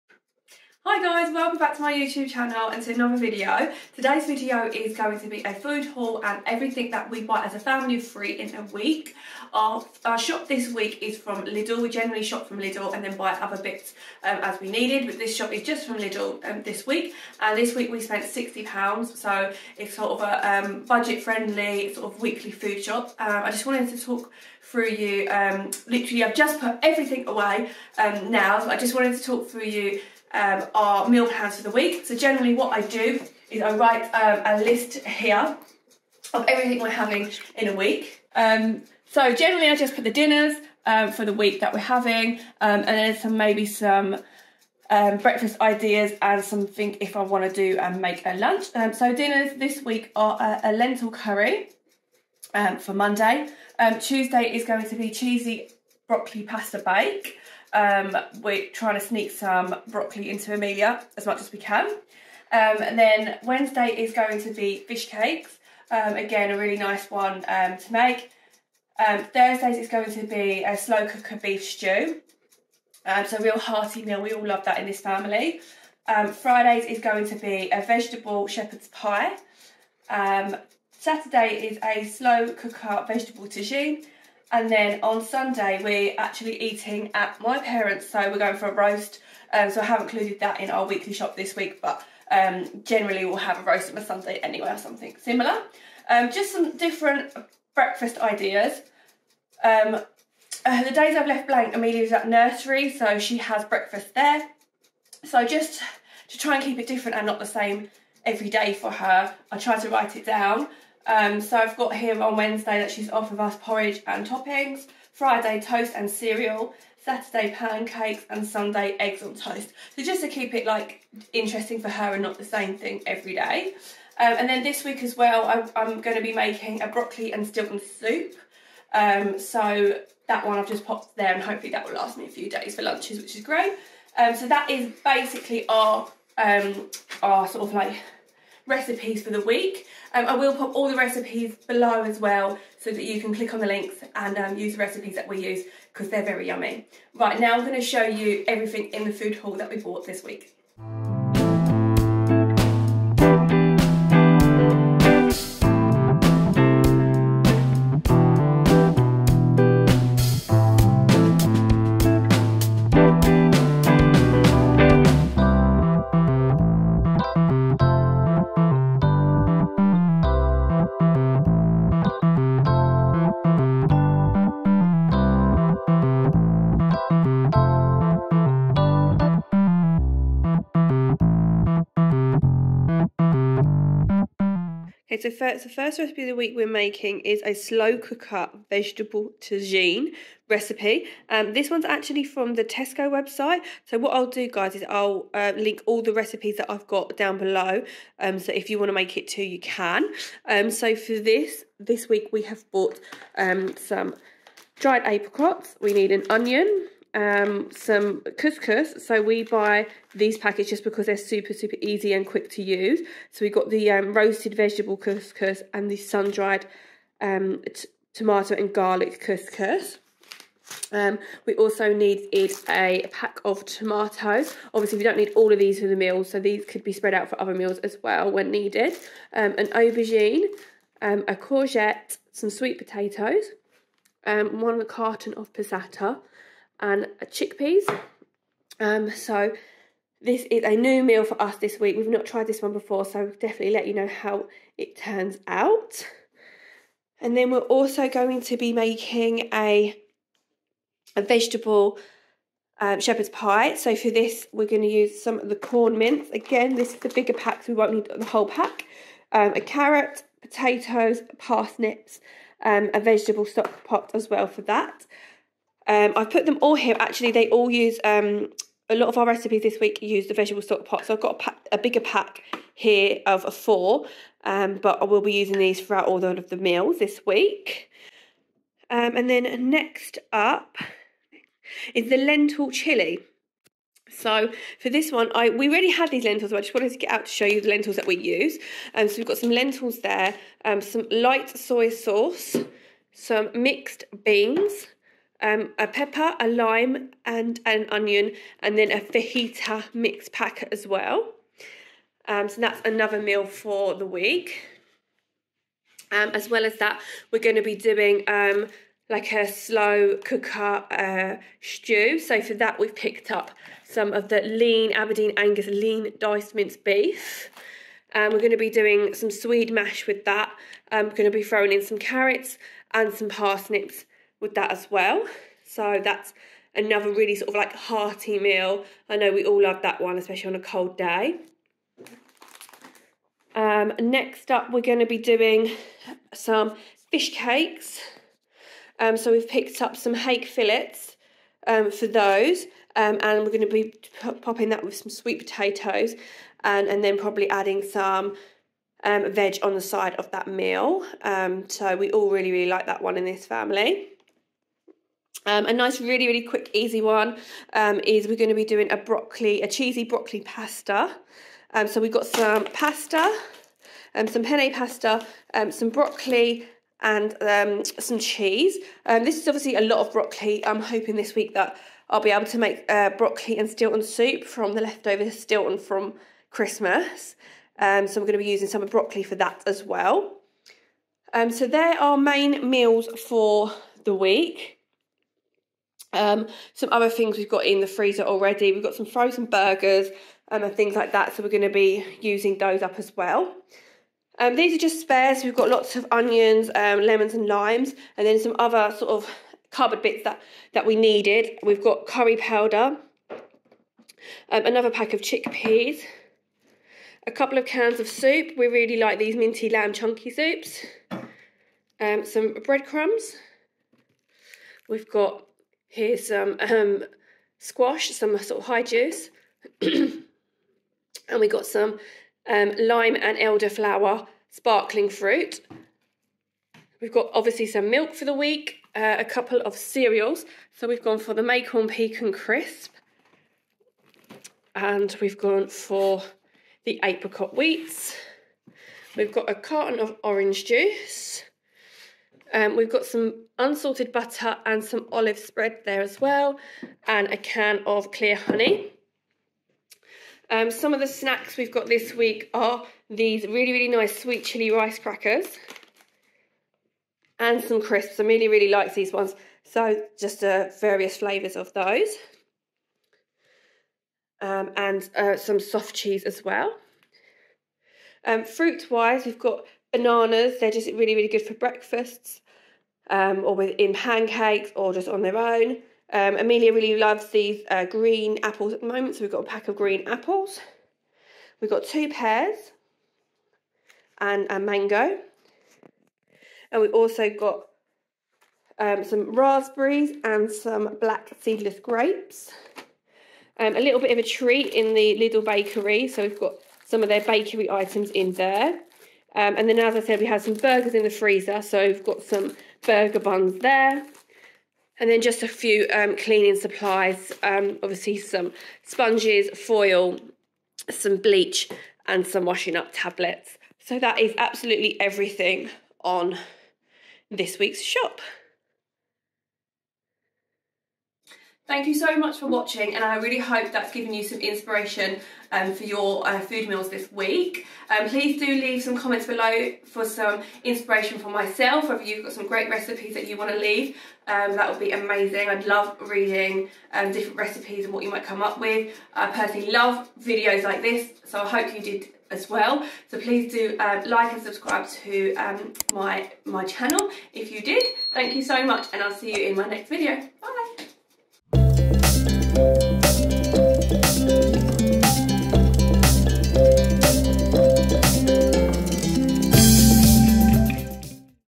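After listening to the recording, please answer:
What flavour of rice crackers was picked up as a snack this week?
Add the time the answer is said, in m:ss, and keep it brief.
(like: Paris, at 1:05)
Sweet chili, at 7:34.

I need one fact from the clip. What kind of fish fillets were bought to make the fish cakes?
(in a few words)
Hake.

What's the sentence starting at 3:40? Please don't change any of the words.
Um, we also needed a pack of tomatoes.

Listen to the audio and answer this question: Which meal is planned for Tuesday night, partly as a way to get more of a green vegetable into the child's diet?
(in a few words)
Cheesy broccoli pasta bake.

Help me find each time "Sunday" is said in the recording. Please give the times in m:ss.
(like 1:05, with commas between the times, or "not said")
1:25, 1:34, 1:58.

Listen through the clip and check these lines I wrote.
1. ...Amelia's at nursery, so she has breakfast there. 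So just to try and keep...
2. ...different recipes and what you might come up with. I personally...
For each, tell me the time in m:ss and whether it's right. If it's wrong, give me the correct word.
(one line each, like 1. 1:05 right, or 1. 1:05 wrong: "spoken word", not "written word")
1. 1:41 right
2. 8:57 right.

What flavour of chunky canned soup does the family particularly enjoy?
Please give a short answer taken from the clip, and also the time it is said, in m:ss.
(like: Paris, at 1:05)
Minty lamb, at 6:49.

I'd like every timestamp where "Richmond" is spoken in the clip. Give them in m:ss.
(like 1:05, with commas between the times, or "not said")
not said.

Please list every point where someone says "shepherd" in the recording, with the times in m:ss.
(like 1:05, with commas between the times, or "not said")
1:18, 4:12.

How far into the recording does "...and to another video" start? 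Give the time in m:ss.
0:02.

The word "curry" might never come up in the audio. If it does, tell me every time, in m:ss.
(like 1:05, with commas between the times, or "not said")
0:51, 6:42.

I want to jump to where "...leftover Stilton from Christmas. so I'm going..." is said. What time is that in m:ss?
6:14.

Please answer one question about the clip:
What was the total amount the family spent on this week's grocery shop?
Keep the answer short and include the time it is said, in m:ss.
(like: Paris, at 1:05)
£60, at 0:18.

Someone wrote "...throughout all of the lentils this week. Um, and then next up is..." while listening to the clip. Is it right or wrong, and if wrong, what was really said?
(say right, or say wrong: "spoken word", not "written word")
wrong: "meals", not "lentils".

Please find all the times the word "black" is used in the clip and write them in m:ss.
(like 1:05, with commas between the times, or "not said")
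8:10.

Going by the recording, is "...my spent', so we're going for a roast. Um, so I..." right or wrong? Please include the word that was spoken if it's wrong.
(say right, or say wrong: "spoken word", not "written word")
wrong: "parents", not "spent".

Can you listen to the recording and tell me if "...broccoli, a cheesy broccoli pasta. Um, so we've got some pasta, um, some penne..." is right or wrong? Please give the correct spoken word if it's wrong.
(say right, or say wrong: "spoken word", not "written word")
right.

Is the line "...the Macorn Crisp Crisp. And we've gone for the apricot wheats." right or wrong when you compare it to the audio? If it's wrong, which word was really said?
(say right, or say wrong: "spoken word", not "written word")
wrong: "Pecan", not "Crisp".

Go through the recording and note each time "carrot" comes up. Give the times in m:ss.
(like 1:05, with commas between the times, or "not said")
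4:19, 5:21.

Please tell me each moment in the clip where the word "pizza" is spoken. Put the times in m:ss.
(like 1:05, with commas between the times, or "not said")
not said.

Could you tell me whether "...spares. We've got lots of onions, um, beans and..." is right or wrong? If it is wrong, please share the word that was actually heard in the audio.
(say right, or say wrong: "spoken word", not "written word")
wrong: "lemons", not "beans".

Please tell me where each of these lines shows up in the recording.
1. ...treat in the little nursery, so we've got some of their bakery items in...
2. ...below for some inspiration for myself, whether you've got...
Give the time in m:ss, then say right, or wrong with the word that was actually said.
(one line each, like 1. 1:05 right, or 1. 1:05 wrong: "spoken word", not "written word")
1. 8:14 wrong: "bakery", not "nursery"
2. 8:49 right.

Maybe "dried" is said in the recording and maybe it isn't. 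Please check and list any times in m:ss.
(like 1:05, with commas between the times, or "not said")
3:24, 3:35.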